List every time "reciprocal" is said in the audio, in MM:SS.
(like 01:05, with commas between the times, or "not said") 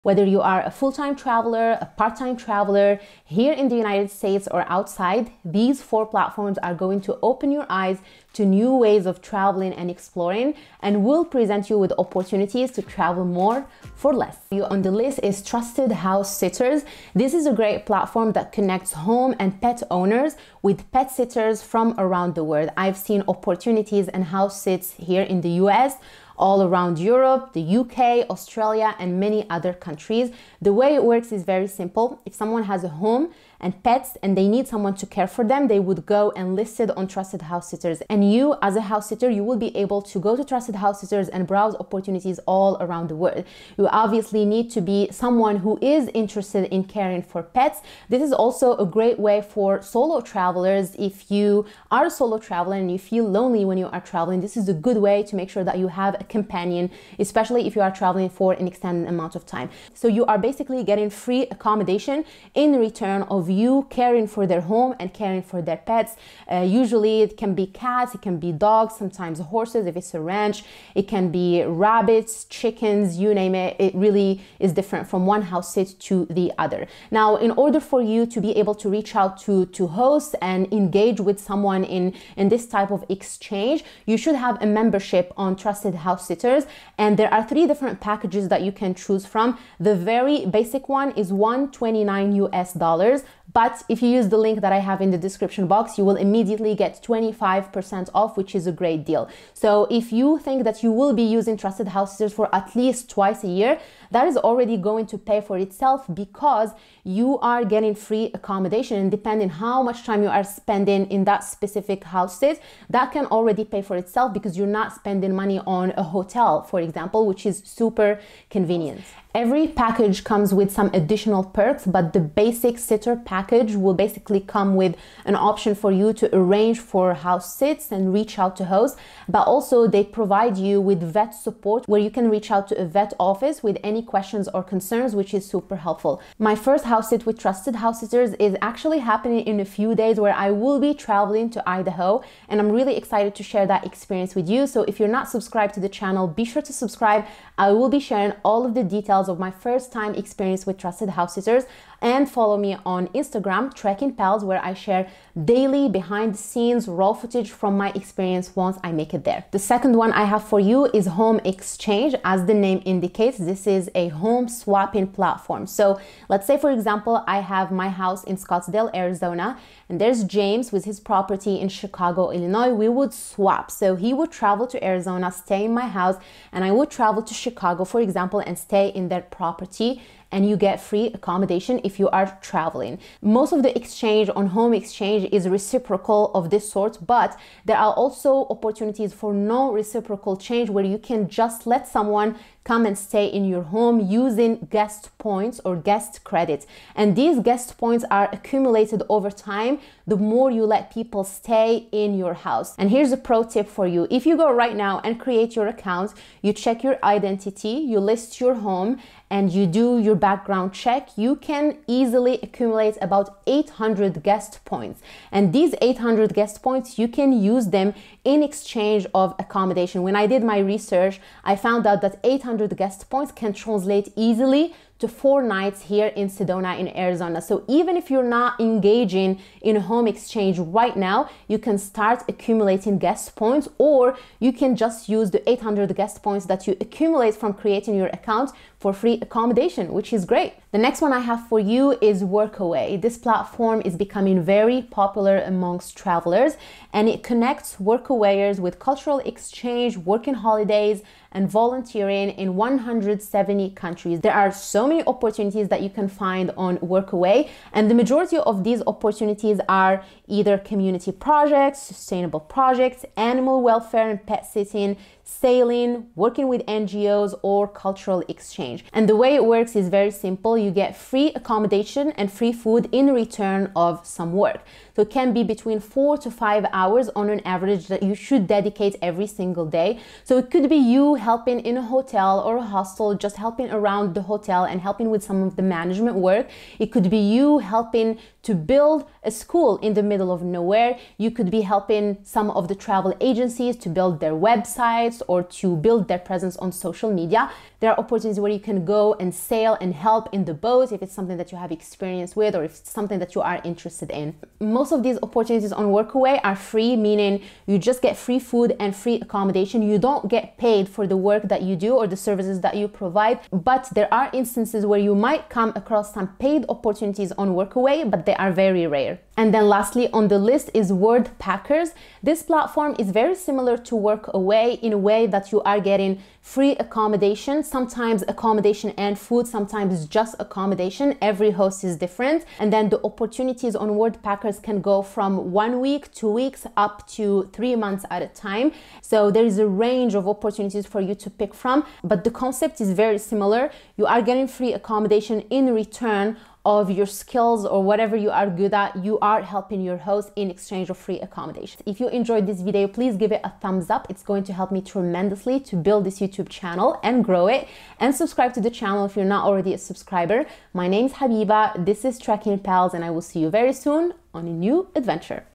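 03:05, 03:09.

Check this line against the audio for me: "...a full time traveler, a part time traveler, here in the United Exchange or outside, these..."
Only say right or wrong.
wrong.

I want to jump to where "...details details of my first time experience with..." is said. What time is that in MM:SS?
02:28.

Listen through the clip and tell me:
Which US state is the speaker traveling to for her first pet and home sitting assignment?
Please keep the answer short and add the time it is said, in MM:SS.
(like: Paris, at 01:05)
Idaho, at 02:21.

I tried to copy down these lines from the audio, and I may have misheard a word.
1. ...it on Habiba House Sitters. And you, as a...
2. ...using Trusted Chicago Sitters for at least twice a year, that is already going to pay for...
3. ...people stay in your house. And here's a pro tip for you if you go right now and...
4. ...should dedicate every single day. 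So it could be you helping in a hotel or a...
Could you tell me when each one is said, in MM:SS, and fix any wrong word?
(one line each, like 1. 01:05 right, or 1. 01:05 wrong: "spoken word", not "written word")
1. 00:36 wrong: "Trusted", not "Habiba"
2. 01:41 wrong: "House", not "Chicago"
3. 03:20 right
4. 04:38 right.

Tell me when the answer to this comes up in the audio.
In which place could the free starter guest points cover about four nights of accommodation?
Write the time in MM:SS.
03:46.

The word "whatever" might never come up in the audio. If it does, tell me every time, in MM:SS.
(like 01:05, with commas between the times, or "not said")
05:47.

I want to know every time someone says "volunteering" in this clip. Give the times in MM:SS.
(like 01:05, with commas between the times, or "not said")
04:11.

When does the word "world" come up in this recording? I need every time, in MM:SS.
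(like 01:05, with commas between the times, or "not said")
00:22, 00:43.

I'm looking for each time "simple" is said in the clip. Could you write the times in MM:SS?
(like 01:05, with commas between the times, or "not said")
00:31, 04:30.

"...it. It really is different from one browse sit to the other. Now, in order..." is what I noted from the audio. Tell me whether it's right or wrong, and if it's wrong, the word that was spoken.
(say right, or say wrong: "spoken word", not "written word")
wrong: "house", not "browse".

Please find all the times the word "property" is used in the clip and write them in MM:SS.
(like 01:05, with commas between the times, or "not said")
02:50, 02:59.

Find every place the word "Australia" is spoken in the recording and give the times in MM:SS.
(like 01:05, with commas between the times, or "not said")
00:28.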